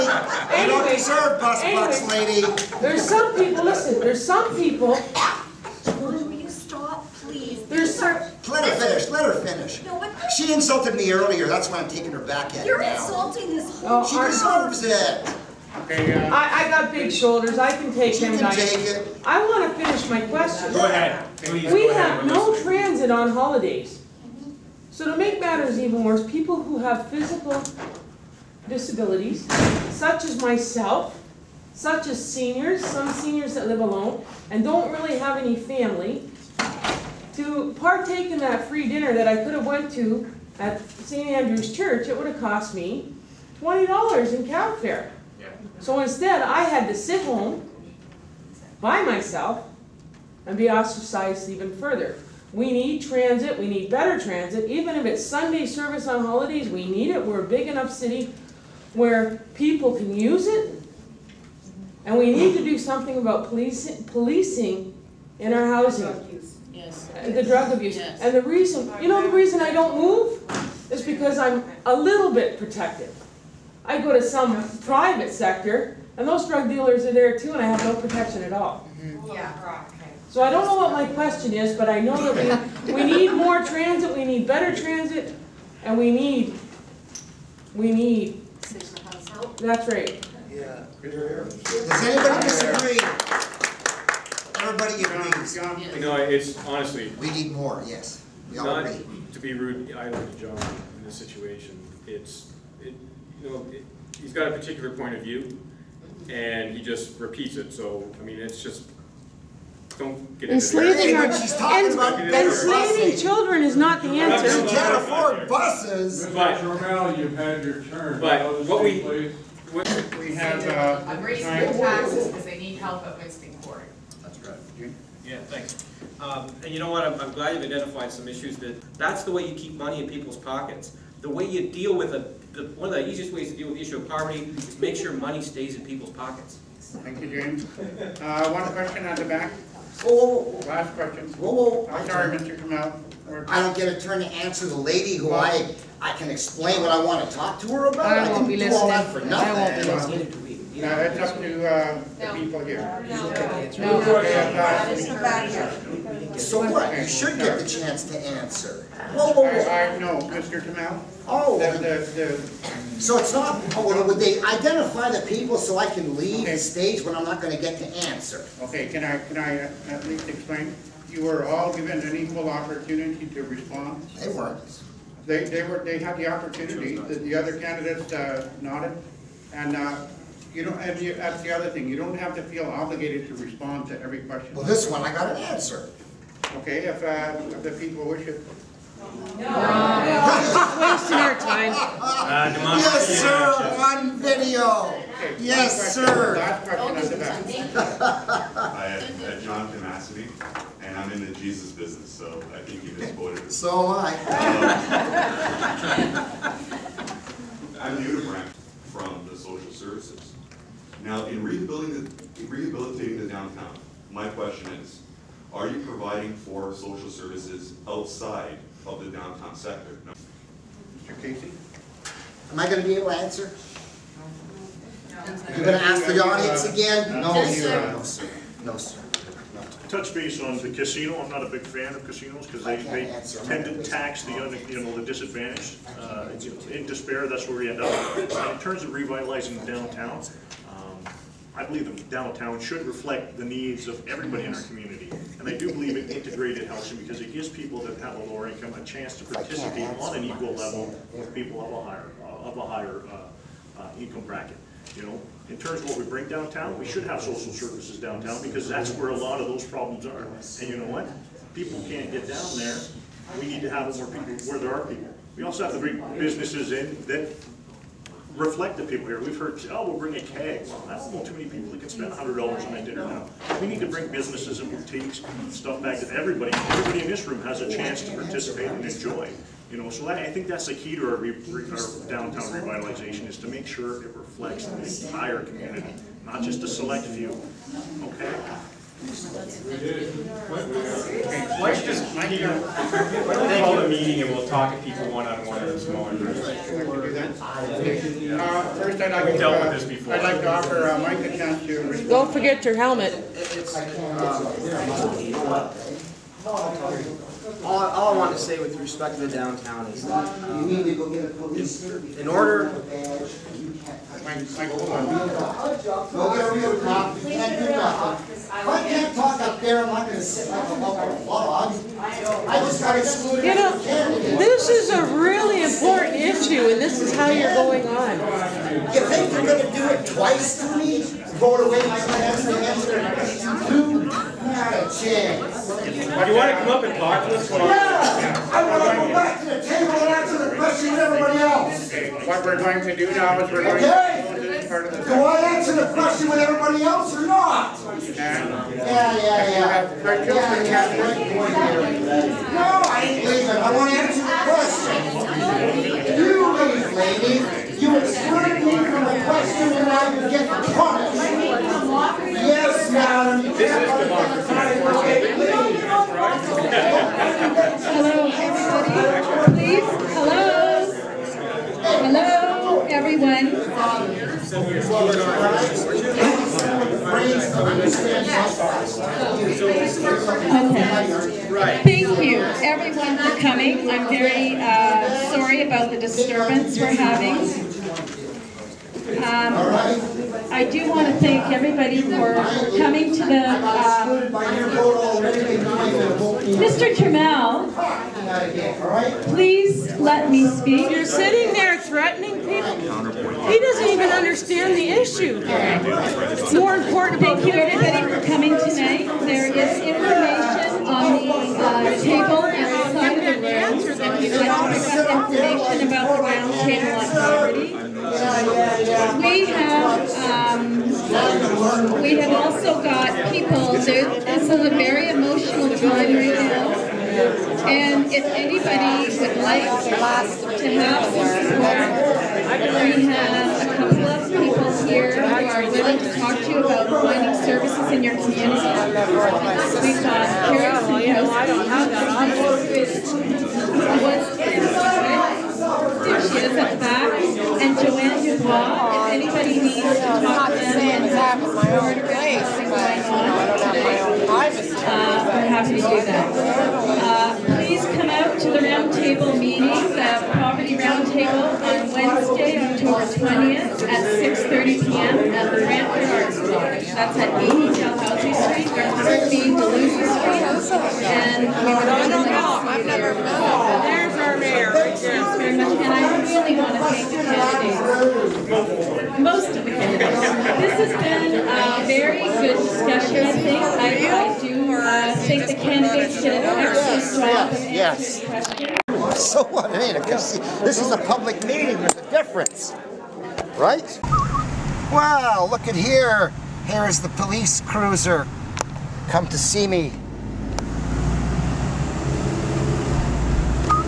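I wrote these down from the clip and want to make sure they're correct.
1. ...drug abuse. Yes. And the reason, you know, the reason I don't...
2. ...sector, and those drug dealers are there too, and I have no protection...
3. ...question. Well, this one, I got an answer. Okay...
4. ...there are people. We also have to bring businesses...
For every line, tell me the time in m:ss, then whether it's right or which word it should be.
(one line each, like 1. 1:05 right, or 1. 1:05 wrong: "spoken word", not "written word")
1. 1:07 right
2. 1:15 right
3. 3:04 right
4. 4:24 right.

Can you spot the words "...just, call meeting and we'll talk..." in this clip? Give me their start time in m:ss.
4:51.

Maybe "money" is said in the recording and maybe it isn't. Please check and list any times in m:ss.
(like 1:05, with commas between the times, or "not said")
2:09, 2:15.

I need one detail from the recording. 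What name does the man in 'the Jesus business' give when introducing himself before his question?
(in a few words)
John Damascene.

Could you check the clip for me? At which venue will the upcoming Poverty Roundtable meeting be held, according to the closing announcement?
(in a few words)
Brantford Arts Lodge.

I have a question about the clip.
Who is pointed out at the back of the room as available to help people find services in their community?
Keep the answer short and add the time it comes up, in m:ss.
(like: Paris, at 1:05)
Carrie Sandowski, at 7:20.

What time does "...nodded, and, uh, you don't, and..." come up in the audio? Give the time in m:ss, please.
2:58.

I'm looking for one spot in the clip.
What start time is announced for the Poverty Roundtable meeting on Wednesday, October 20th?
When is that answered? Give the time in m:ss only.
7:44.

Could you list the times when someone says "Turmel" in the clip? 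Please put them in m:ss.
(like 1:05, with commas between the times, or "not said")
1:56, 6:36.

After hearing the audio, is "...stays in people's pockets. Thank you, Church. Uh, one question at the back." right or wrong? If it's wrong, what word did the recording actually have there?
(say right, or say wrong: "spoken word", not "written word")
wrong: "James", not "Church".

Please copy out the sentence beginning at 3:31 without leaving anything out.
Now, in rehabilitating the, in rehabilitating the downtown, my question is, are you providing for social services outside of the downtown sector?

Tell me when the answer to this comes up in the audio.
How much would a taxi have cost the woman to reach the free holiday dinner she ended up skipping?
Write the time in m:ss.
0:43.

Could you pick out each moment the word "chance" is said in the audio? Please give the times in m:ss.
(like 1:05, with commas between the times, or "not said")
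2:37, 4:08, 4:37, 5:01, 5:34.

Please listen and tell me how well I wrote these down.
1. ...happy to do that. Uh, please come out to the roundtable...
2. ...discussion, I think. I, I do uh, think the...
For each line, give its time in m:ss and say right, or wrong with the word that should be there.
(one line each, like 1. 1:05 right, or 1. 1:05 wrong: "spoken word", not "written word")
1. 7:35 right
2. 8:02 right.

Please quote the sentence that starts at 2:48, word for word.
okay, can I, can I uh, at least explain?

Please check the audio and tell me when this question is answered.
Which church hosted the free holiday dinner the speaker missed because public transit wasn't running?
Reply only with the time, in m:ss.
0:40.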